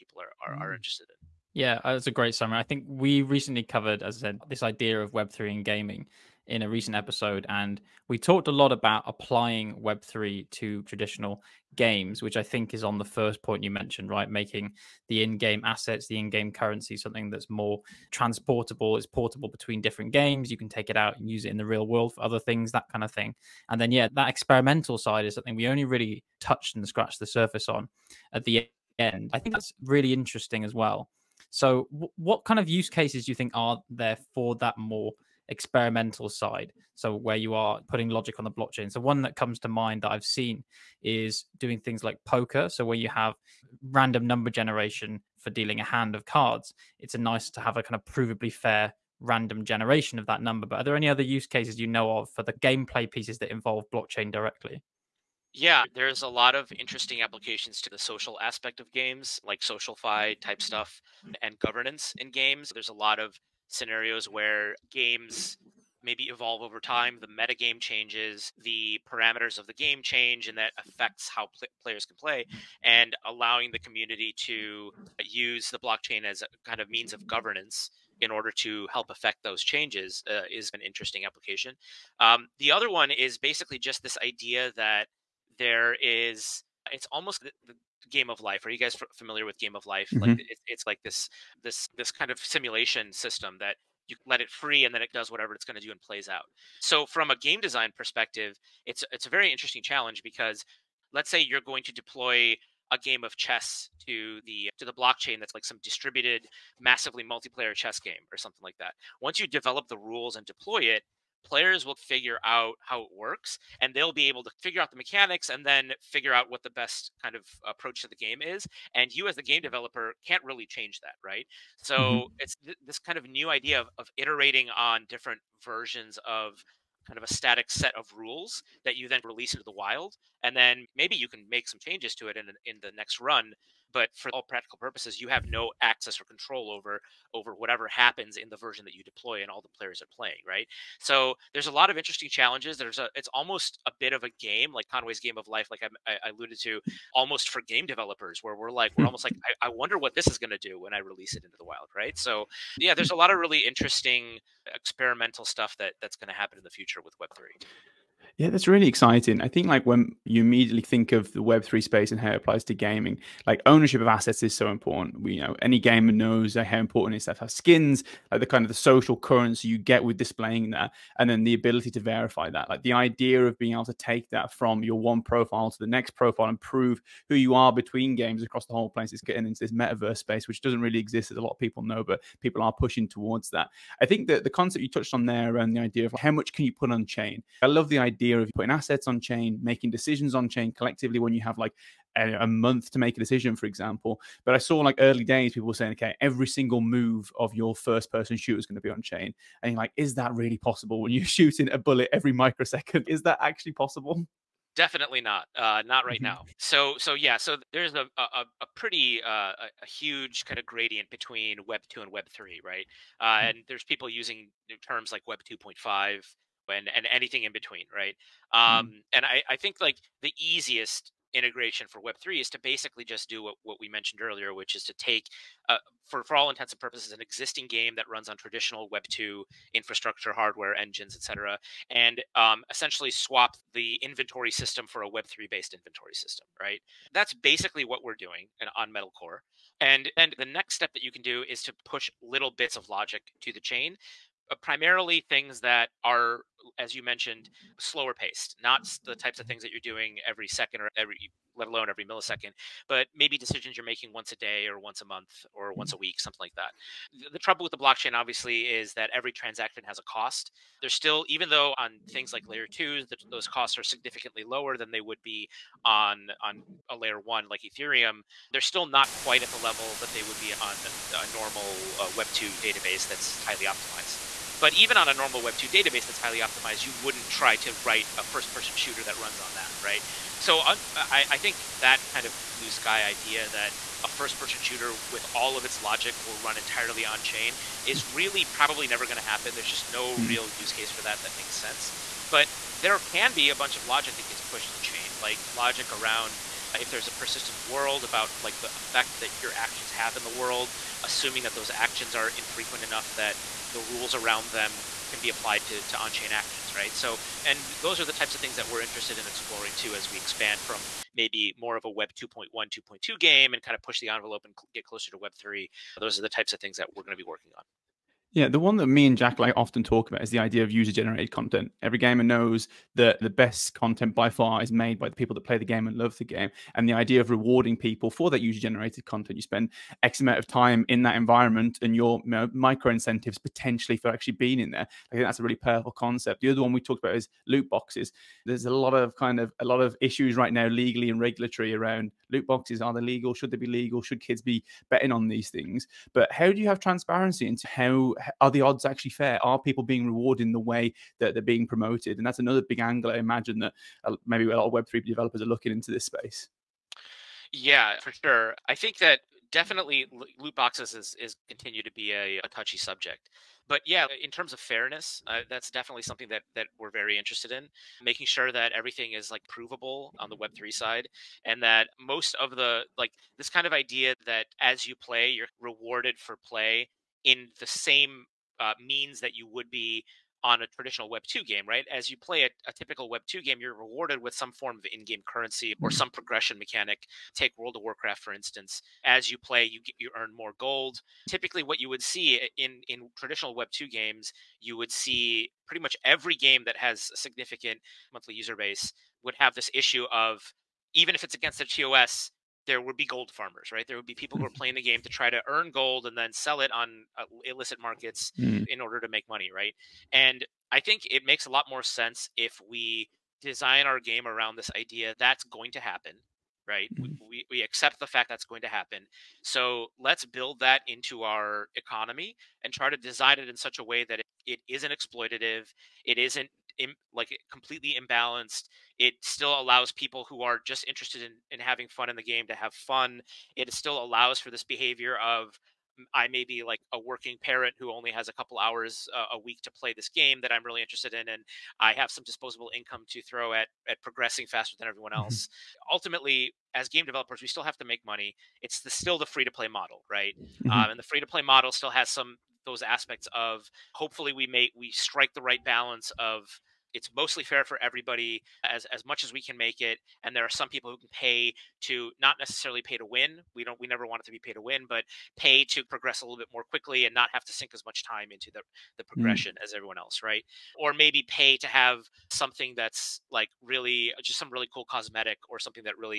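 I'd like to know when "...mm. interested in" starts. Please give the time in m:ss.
0:00.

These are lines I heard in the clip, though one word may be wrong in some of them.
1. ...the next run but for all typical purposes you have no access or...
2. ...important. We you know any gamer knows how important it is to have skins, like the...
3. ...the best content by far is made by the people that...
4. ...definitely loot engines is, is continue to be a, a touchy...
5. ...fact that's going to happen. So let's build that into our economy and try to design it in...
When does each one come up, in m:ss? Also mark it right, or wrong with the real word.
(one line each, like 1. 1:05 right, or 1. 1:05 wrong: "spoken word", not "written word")
1. 2:12 wrong: "practical", not "typical"
2. 2:44 right
3. 5:23 right
4. 5:59 wrong: "boxes", not "engines"
5. 6:58 right.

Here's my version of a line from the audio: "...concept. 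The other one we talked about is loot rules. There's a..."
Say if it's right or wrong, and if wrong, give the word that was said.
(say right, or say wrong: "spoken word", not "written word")
wrong: "boxes", not "rules".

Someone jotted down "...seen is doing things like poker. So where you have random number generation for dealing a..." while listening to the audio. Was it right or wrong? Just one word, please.
right.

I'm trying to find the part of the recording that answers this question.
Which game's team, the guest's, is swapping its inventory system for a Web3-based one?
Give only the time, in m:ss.
3:58.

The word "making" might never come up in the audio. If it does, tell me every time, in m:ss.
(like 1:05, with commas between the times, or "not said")
0:14, 3:09, 4:13, 6:08.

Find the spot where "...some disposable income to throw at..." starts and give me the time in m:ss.
7:22.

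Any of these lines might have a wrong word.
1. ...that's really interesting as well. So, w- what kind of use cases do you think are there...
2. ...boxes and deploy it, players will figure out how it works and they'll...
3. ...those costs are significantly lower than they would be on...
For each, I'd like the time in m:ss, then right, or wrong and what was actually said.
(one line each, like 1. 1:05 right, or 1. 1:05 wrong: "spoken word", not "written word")
1. 0:29 right
2. 1:49 wrong: "rules", not "boxes"
3. 4:23 right.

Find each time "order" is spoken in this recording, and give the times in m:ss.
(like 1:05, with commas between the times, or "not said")
1:18, 6:48.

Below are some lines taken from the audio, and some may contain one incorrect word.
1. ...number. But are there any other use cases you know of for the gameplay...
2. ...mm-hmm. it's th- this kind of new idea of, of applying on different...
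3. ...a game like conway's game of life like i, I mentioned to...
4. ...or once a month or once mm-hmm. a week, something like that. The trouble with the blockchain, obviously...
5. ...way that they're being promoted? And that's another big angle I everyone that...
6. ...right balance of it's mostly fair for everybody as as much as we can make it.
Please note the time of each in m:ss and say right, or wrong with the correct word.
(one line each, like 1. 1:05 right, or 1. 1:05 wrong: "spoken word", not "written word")
1. 0:50 right
2. 2:01 wrong: "iterating", not "applying"
3. 2:24 wrong: "alluded", not "mentioned"
4. 4:14 right
5. 5:50 wrong: "imagine", not "everyone"
6. 7:35 right.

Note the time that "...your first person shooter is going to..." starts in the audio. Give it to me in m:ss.
3:17.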